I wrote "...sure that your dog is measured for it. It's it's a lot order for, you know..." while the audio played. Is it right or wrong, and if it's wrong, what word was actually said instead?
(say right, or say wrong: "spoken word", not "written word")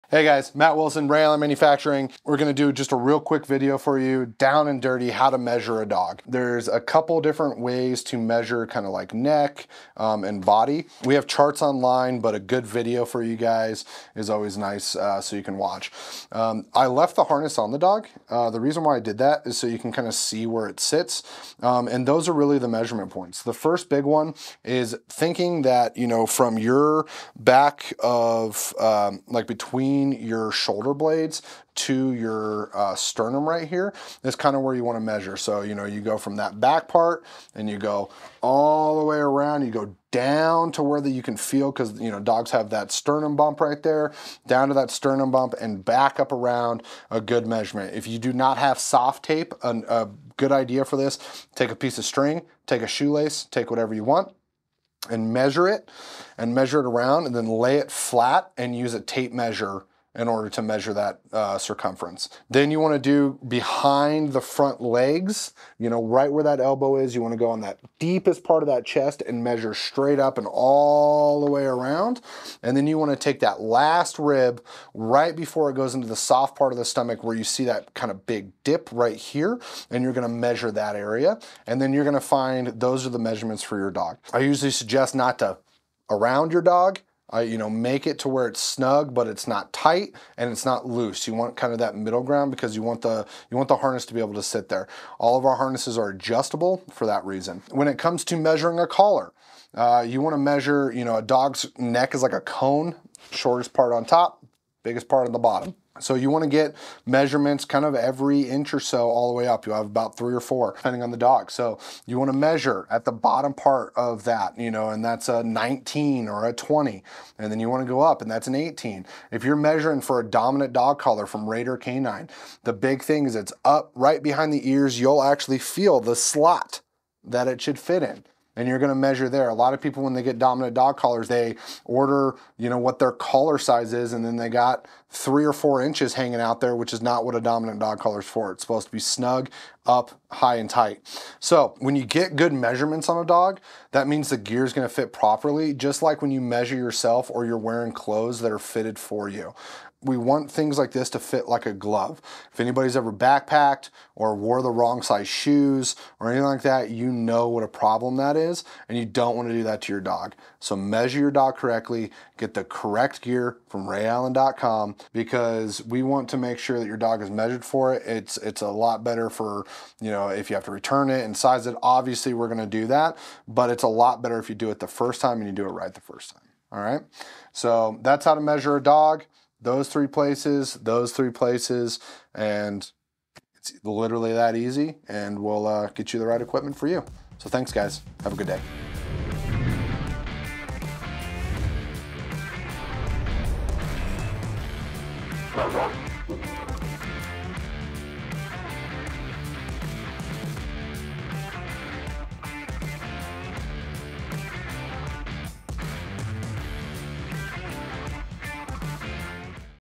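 wrong: "better", not "order".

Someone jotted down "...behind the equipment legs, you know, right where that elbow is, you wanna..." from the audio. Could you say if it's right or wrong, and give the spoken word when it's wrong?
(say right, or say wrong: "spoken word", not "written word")
wrong: "front", not "equipment".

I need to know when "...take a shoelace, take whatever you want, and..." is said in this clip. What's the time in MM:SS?
00:52.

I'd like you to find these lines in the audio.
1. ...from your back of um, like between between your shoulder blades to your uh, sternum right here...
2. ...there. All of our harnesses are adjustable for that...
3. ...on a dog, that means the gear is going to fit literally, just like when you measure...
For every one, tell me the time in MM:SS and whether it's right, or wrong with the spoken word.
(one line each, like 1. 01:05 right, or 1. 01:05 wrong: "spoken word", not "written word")
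1. 00:26 right
2. 01:34 right
3. 02:23 wrong: "properly", not "literally".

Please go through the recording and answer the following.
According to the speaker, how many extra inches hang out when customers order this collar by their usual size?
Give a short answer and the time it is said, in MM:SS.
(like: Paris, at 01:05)
3 or 4 inches, at 02:15.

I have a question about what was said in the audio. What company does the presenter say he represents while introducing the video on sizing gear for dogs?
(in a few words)
Ray Allen Manufacturing.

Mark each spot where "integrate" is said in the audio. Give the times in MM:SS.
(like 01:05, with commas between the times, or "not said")
not said.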